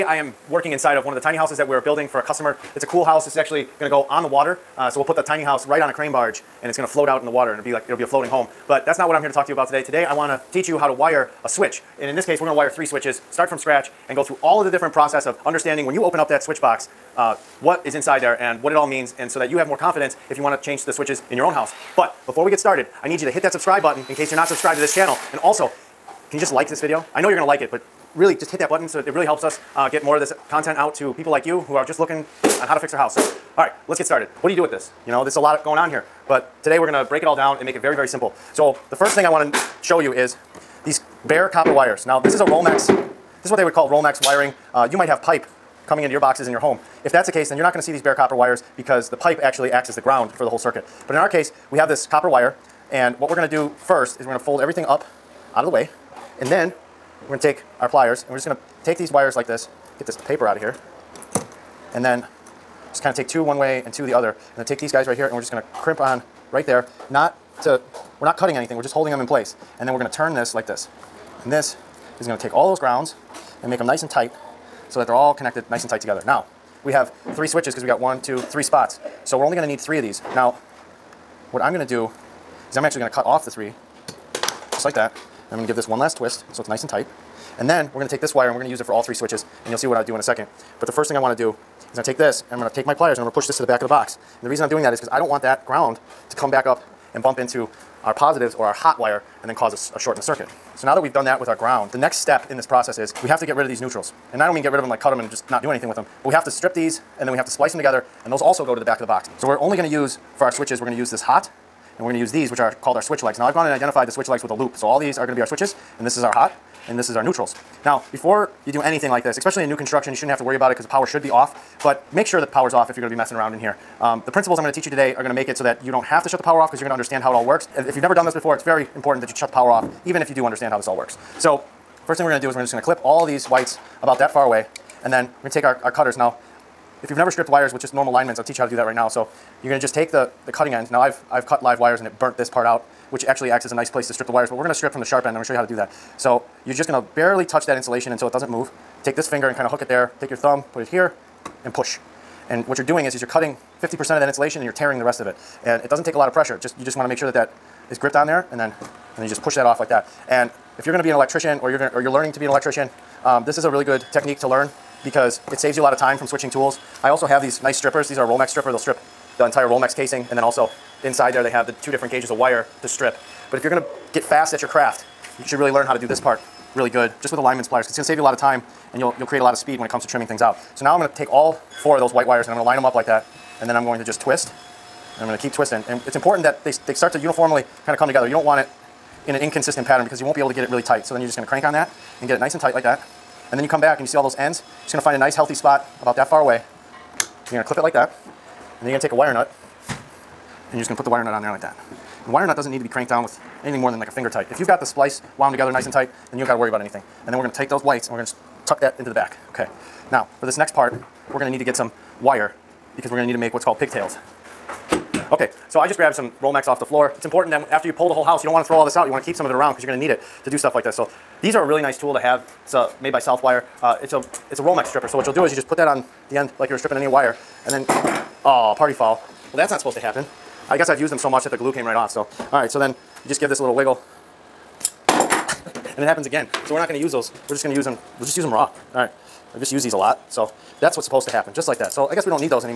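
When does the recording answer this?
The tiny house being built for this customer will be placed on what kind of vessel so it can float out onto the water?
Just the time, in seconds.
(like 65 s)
5 s.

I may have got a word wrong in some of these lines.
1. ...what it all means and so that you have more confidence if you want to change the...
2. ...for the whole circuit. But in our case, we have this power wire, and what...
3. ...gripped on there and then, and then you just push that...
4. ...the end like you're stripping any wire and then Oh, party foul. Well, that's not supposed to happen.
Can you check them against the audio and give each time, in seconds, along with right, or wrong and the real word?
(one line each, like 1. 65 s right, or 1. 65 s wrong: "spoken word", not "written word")
1. 18 s right
2. 50 s wrong: "copper", not "power"
3. 157 s right
4. 226 s right.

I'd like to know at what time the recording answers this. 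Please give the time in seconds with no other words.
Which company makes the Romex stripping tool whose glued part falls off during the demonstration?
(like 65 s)
223 s.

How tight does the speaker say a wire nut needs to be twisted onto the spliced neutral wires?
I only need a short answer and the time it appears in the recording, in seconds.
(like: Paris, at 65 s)
Finger tight, at 204 s.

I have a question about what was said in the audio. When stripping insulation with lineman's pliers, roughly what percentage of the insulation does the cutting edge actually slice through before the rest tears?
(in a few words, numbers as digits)
50%.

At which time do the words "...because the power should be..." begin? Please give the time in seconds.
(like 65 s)
120 s.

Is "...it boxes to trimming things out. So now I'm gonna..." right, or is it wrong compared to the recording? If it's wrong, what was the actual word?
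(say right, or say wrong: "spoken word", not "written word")
wrong: "comes", not "boxes".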